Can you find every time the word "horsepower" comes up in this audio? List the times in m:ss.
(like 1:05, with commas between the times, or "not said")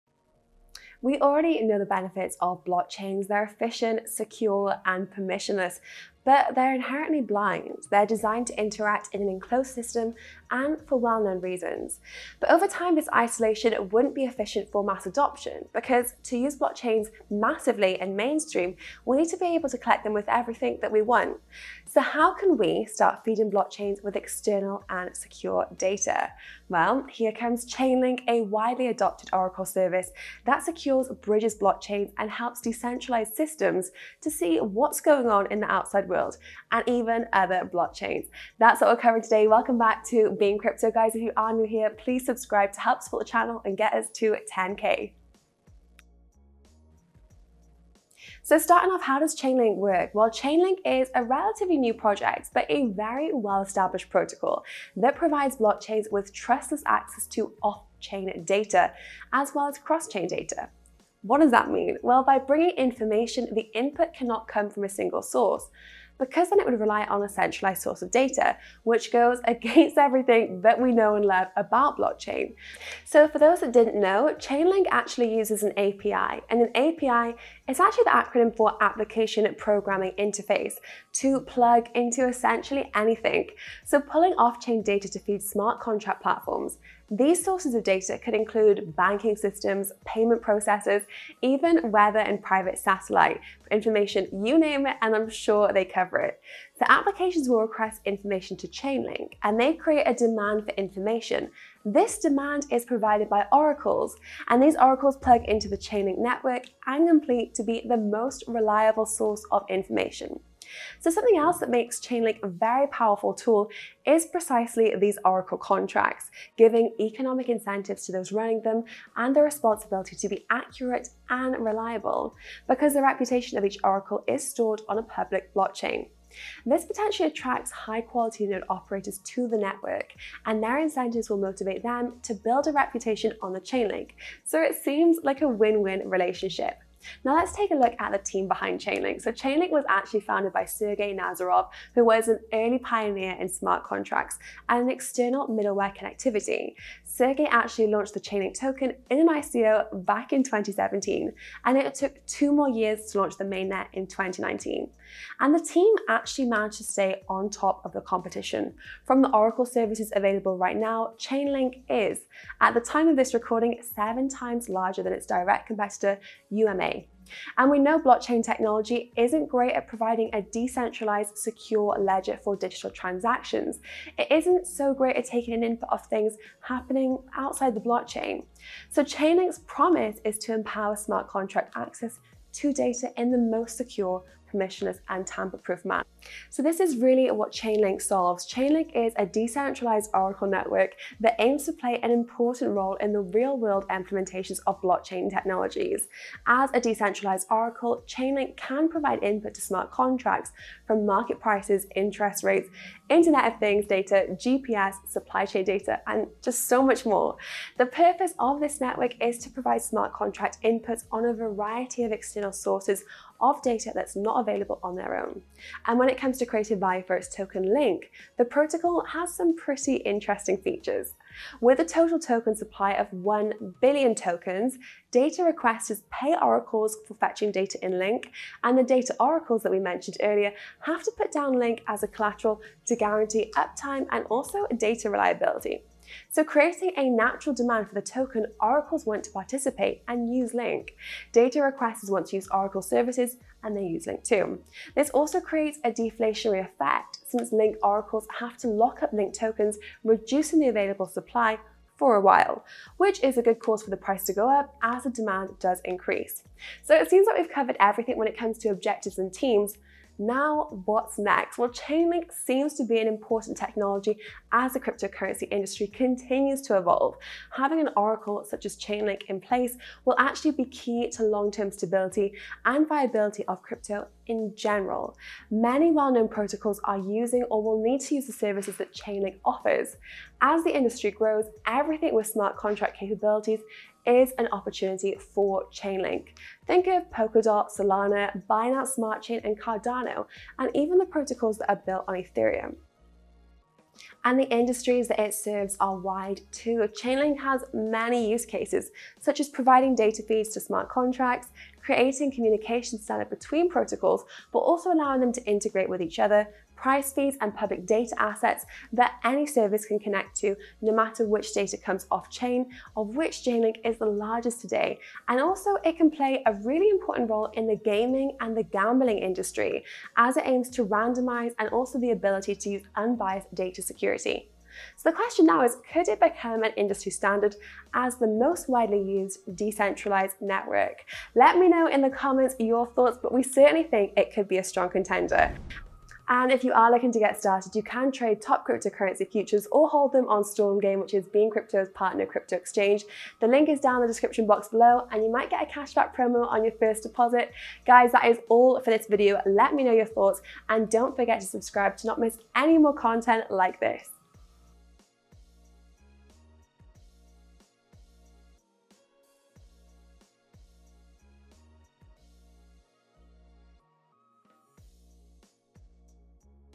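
not said.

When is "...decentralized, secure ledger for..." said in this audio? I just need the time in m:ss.
2:50.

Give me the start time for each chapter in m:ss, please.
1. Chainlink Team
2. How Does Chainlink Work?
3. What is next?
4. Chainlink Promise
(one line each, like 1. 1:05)
1. 2:17
2. 0:47
3. 4:20
4. 2:48.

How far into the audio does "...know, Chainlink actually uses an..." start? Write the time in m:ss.
1:13.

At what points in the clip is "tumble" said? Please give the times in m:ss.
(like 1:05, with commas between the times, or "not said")
not said.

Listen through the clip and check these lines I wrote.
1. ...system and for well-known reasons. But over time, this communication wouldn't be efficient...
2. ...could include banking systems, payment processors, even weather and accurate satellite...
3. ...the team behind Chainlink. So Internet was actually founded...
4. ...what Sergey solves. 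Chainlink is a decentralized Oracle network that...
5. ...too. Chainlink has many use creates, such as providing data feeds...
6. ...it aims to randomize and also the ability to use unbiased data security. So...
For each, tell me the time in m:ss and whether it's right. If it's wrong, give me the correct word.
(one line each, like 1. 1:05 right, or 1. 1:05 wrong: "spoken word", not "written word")
1. 0:09 wrong: "isolation", not "communication"
2. 1:28 wrong: "private", not "accurate"
3. 2:18 wrong: "Chainlink", not "Internet"
4. 3:07 wrong: "Chainlink", not "Sergey"
5. 4:56 wrong: "cases", not "creates"
6. 5:20 right.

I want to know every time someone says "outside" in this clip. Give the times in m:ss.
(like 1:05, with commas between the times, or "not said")
0:35, 2:57.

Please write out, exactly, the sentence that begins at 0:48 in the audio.
So starting off, how does Chainlink work?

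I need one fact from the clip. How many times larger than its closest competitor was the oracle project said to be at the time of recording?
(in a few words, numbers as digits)
7.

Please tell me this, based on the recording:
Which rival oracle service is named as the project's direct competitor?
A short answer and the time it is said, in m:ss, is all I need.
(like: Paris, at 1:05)
UMA, at 2:46.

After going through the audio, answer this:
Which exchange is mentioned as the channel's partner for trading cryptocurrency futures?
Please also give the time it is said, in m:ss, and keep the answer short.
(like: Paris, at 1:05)
Stormgain, at 5:40.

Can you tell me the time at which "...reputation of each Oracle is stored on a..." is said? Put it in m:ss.
2:03.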